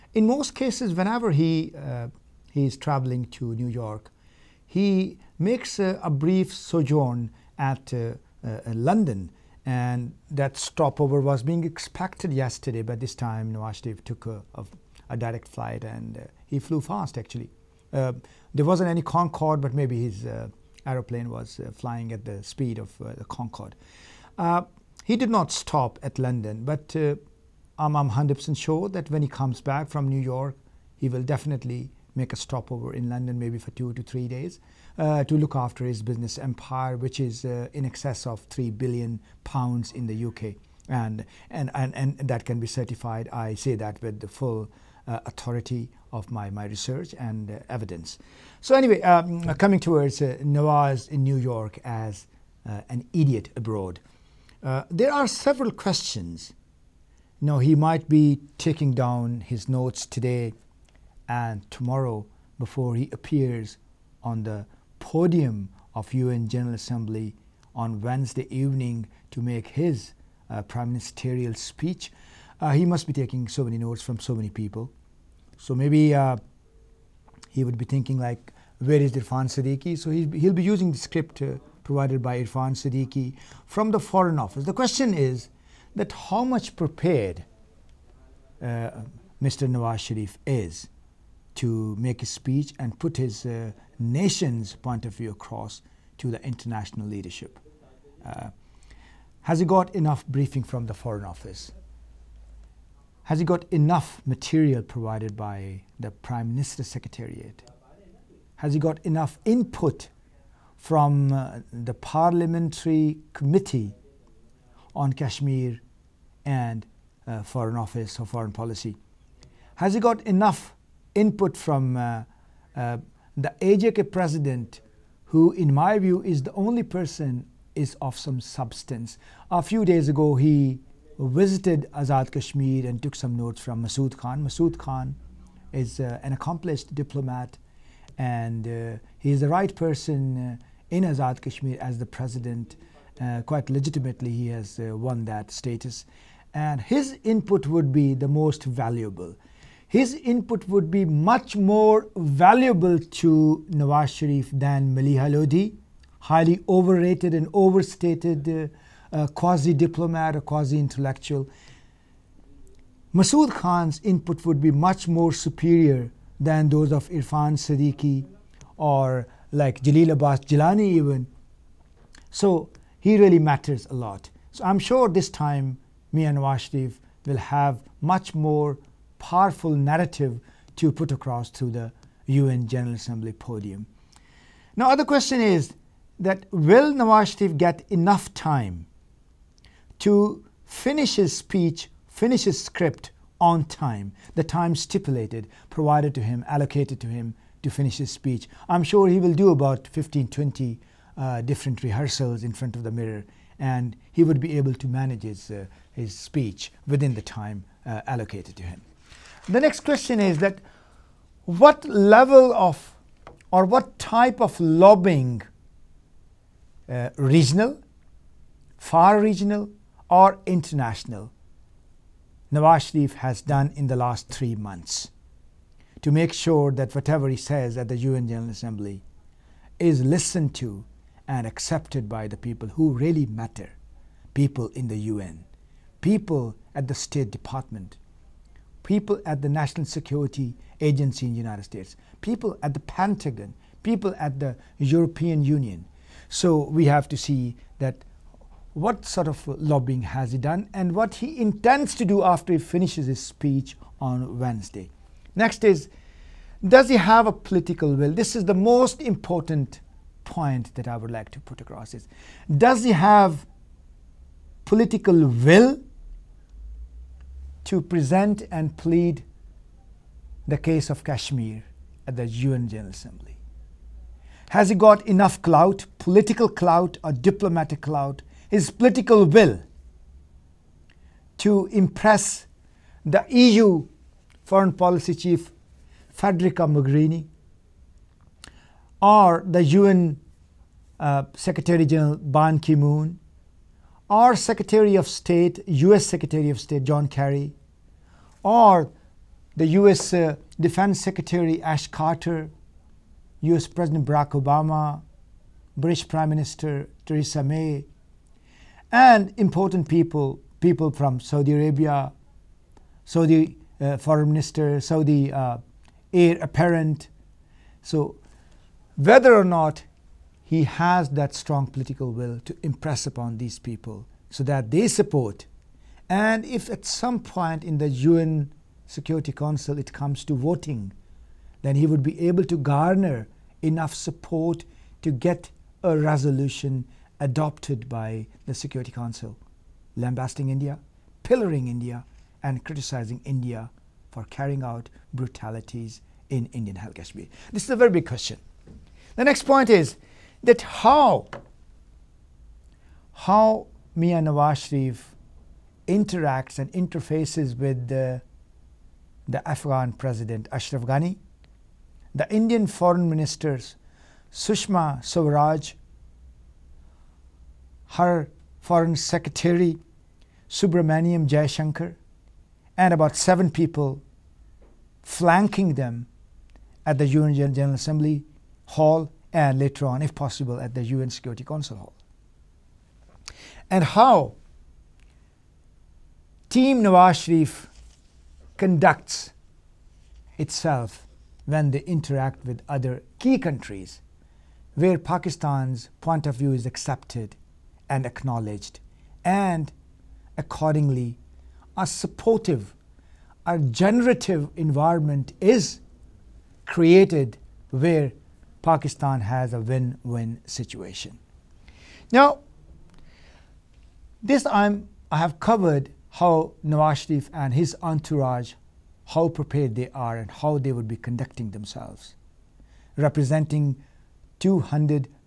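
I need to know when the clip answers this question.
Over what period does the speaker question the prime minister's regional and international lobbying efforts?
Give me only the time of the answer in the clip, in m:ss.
3:44.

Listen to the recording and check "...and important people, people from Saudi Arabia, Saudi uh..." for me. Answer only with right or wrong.
right.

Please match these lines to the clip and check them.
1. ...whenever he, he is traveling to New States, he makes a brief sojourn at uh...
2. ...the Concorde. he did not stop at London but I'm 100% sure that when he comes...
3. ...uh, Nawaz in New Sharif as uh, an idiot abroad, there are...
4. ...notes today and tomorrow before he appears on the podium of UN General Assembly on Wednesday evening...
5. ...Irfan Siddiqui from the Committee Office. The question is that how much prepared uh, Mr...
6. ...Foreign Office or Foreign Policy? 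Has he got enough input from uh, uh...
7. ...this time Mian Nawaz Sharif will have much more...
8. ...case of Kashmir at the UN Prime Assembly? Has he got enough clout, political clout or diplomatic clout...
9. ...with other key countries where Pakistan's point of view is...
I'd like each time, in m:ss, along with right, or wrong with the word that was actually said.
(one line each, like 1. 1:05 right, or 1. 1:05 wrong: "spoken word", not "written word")
1. 0:00 wrong: "York", not "States"
2. 0:22 right
3. 0:50 wrong: "York", not "Sharif"
4. 0:59 right
5. 1:22 wrong: "Foreign", not "Committee"
6. 1:57 right
7. 2:55 right
8. 4:30 wrong: "General", not "Prime"
9. 6:32 right.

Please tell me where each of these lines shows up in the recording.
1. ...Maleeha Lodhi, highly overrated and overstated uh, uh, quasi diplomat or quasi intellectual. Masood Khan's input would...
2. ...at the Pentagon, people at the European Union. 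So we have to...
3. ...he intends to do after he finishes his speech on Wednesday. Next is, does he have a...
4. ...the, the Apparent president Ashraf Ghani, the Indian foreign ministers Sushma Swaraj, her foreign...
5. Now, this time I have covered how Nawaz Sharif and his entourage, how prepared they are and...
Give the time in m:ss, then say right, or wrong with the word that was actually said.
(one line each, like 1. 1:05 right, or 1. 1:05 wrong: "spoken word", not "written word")
1. 2:34 right
2. 4:02 right
3. 4:11 right
4. 5:57 wrong: "Afghan", not "Apparent"
5. 6:52 right.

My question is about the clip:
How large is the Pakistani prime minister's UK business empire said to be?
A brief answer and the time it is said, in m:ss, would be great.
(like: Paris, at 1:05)
3 billion pounds, at 0:38.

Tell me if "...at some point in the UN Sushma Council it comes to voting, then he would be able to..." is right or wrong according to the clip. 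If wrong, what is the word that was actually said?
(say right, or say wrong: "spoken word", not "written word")
wrong: "Security", not "Sushma".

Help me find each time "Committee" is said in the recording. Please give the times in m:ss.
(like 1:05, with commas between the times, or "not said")
1:53.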